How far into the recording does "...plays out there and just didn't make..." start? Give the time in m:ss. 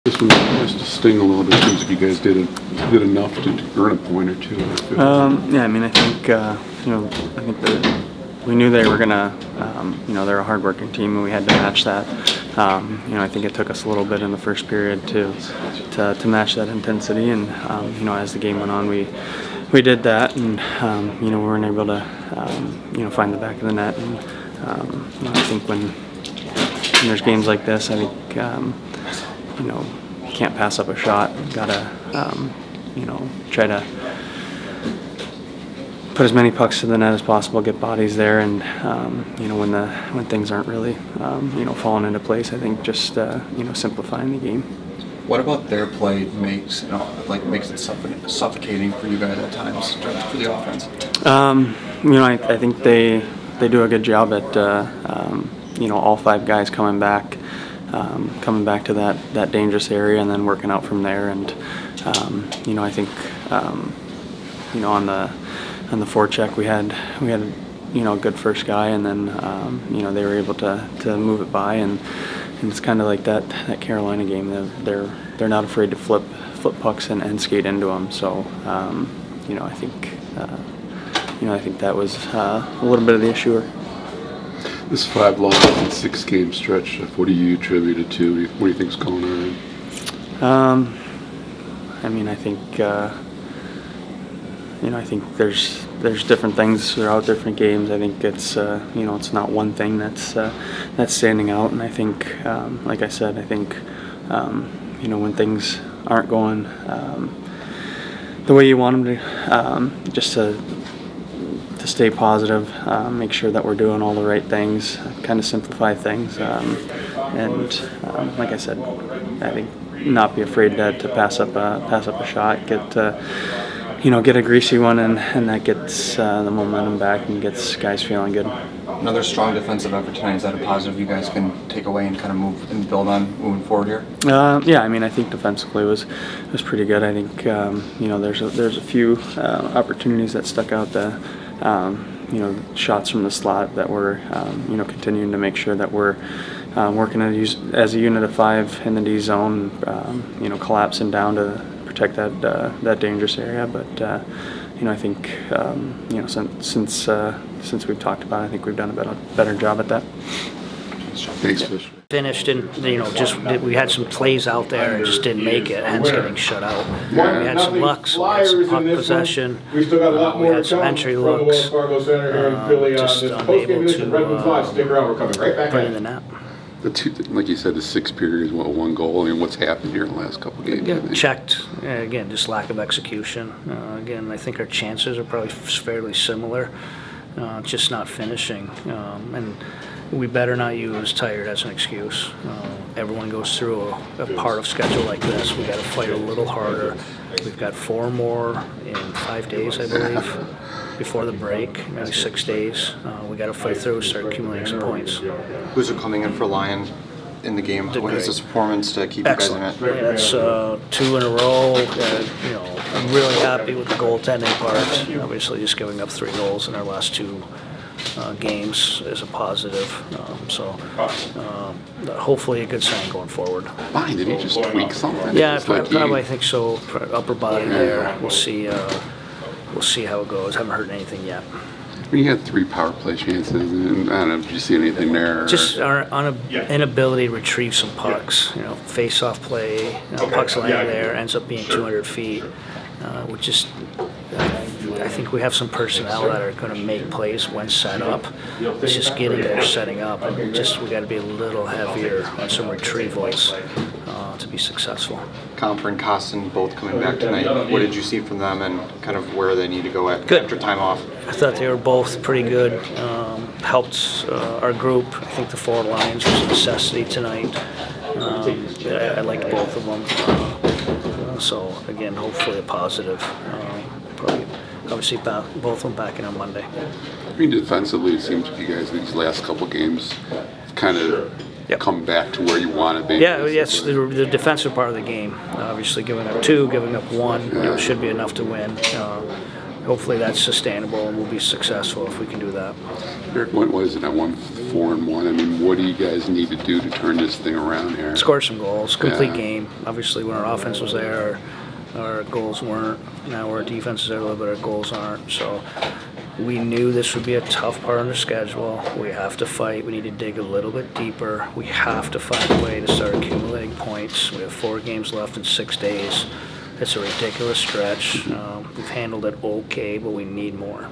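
2:44.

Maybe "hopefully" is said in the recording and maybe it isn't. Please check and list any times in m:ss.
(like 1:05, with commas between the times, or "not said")
3:42, 4:32, 4:49.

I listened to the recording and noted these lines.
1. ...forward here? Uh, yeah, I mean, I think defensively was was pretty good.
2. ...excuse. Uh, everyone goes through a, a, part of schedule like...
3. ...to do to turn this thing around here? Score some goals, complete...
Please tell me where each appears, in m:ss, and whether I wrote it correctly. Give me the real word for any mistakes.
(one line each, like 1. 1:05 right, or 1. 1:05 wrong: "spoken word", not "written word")
1. 2:13 right
2. 3:11 right
3. 4:56 right.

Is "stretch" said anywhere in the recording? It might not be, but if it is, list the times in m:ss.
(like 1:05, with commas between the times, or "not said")
1:26, 5:17.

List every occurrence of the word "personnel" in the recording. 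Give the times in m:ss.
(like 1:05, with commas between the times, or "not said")
4:05.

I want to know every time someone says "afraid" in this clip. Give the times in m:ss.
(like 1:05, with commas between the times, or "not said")
1:15, 2:00.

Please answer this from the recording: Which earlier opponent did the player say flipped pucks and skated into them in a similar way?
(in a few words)
Carolina.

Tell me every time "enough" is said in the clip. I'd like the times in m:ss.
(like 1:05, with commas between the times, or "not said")
0:03, 4:48.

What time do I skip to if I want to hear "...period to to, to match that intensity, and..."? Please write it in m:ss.
0:14.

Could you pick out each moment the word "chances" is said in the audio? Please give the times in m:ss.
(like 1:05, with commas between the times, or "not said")
3:04, 3:53.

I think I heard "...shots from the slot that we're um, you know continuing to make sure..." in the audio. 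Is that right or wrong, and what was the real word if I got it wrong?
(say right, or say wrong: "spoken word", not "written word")
right.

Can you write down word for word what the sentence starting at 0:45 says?
What about their play makes you know, like makes it suffocating for you guys at times for the offense?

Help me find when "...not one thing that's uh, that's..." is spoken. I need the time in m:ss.
1:39.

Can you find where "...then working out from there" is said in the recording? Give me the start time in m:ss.
1:00.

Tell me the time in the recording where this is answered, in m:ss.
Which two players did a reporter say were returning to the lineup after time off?
4:15.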